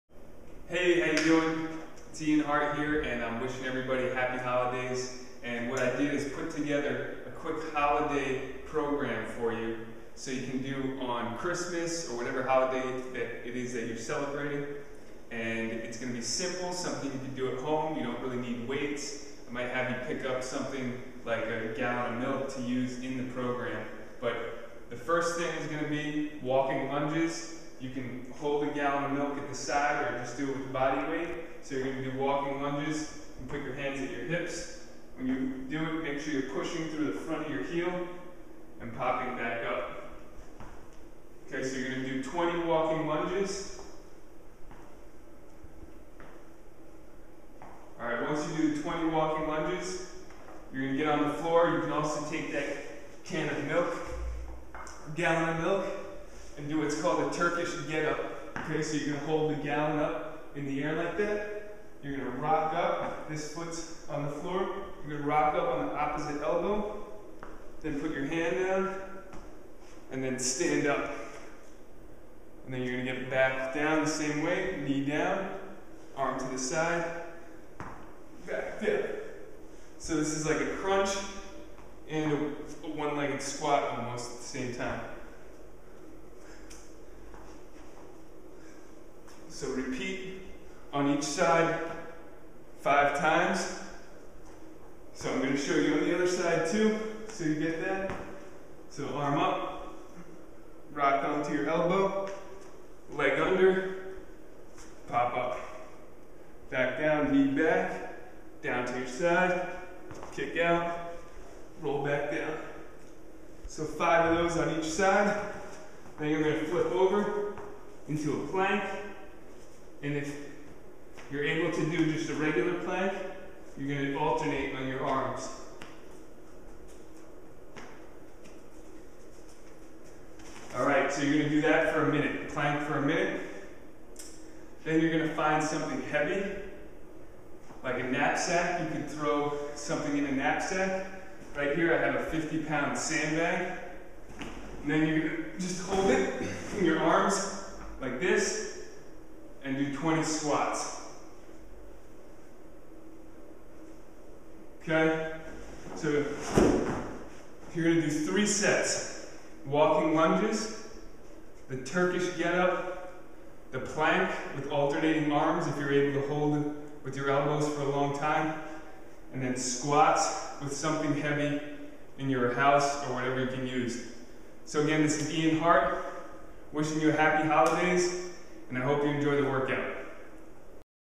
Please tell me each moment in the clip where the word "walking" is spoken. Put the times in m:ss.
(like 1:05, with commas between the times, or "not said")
0:26, 0:32, 0:42, 0:49, 2:39.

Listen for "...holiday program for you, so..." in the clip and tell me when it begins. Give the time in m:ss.
0:07.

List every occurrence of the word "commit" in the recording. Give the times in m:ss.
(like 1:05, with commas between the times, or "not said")
not said.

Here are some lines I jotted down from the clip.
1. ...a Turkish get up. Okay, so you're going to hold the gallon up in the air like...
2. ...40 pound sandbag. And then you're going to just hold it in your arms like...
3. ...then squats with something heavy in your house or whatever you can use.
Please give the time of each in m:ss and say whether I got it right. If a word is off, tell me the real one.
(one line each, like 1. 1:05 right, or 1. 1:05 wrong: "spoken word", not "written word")
1. 0:57 right
2. 2:22 wrong: "50", not "40"
3. 2:49 right.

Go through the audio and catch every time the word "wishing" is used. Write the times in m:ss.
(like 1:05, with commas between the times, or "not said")
0:03, 2:56.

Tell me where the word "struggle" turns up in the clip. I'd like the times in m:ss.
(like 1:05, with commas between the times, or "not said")
not said.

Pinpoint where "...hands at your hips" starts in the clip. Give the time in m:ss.
0:33.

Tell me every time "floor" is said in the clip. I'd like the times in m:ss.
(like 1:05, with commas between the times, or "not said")
0:51, 1:04.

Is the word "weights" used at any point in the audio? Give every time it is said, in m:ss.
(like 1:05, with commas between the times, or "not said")
0:18, 0:31.